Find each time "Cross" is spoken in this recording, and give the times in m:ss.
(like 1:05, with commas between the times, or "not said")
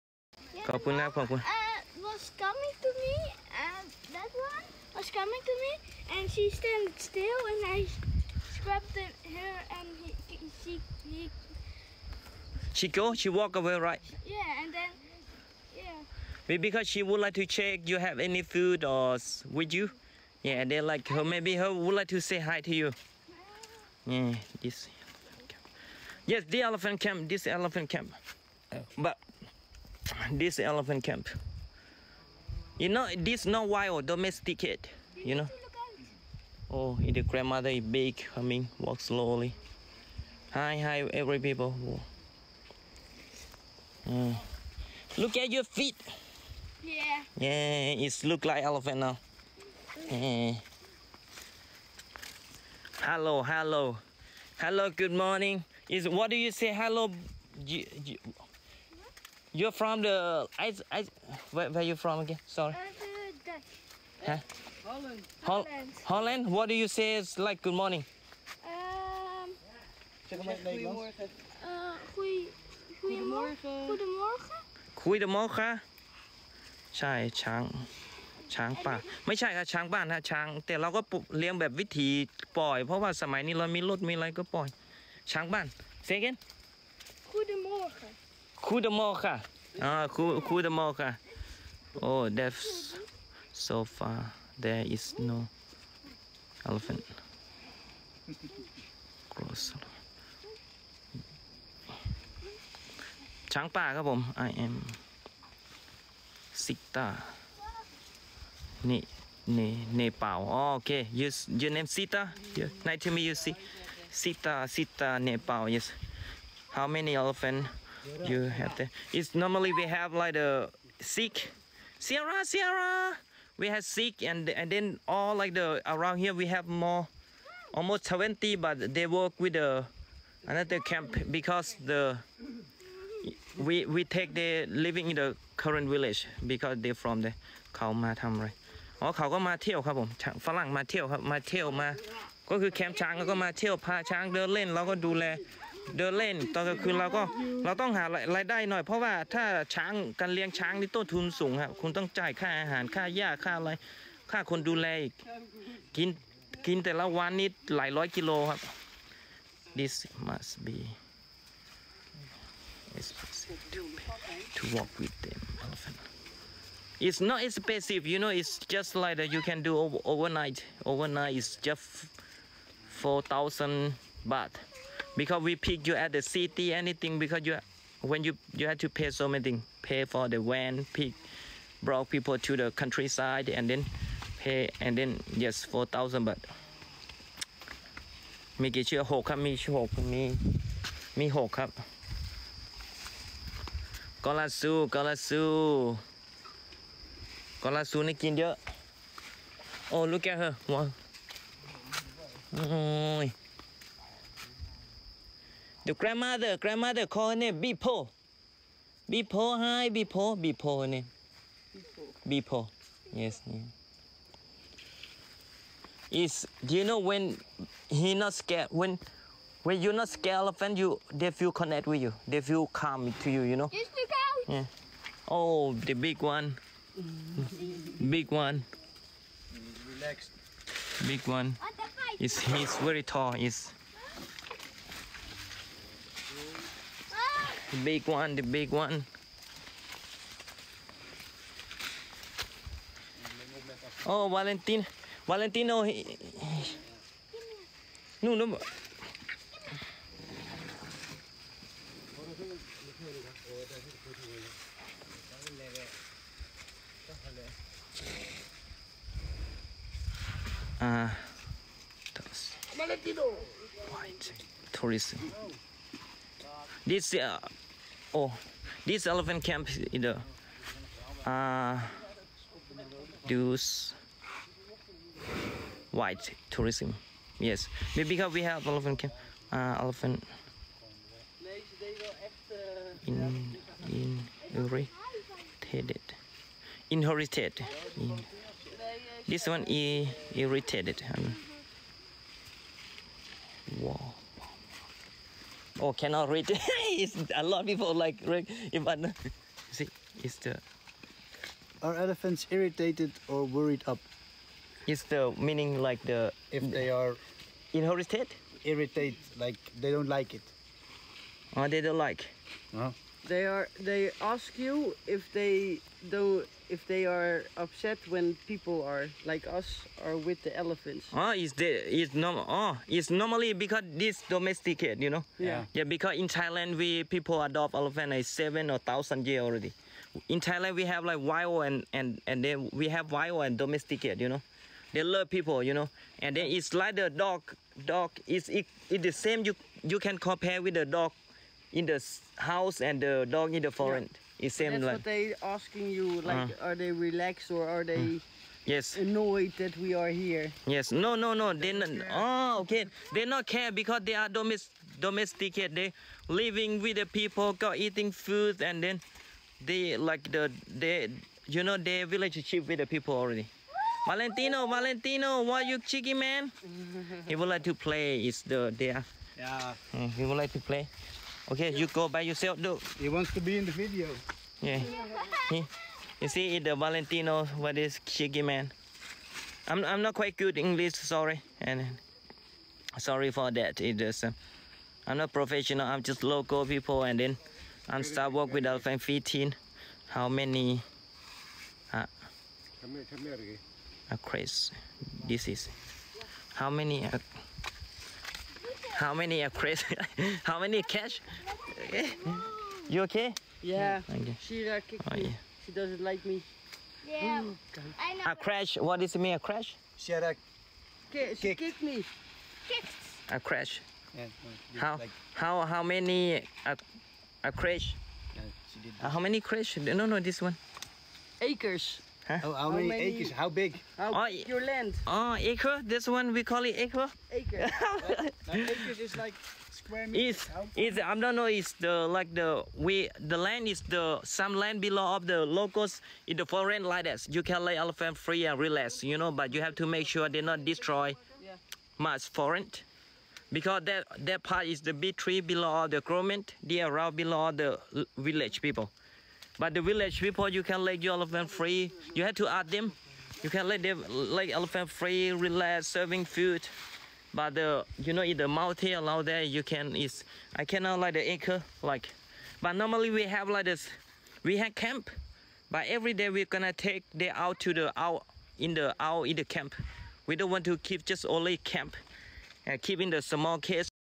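1:39.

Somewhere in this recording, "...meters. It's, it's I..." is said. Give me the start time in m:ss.
7:10.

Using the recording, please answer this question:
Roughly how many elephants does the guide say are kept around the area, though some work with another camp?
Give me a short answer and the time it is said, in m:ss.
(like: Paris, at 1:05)
20, at 2:07.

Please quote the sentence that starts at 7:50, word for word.
We don't want to keep just only camp.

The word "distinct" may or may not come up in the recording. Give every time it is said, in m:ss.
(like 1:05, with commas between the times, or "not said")
not said.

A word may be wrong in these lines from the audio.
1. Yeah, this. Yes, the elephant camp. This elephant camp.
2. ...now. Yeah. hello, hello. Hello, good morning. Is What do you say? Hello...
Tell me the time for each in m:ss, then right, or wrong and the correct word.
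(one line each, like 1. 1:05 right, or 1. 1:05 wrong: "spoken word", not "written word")
1. 0:24 right
2. 0:48 right.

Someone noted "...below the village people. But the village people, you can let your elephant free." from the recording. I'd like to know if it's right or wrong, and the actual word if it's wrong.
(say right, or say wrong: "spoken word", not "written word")
right.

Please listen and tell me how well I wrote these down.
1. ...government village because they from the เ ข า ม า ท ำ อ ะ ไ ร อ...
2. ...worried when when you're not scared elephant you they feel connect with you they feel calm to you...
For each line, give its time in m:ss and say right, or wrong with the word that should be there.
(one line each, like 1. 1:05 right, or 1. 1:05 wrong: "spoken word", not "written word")
1. 2:15 wrong: "current", not "government"
2. 3:38 wrong: "scared", not "worried".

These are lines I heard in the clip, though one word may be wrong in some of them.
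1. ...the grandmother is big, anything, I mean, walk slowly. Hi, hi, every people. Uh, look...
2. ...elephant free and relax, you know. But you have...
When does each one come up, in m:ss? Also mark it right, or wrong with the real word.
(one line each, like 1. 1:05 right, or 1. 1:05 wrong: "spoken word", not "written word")
1. 0:36 wrong: "coming", not "anything"
2. 7:17 right.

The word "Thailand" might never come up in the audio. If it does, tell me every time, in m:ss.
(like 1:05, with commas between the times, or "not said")
5:26, 5:30.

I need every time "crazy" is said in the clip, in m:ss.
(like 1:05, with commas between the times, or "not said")
6:39.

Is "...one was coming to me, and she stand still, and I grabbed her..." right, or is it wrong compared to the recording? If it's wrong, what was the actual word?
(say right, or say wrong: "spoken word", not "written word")
right.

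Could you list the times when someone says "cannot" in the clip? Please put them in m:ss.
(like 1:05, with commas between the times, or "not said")
4:55, 7:40.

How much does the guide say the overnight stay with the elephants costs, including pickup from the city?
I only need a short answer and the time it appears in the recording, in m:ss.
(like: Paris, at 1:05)
4,000 baht, at 2:53.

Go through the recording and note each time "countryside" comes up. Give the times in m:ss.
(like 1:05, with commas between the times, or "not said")
3:02.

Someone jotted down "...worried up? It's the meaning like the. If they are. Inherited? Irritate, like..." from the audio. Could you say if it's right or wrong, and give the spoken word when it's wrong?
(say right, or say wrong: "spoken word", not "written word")
right.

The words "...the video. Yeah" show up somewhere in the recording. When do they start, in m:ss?
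6:13.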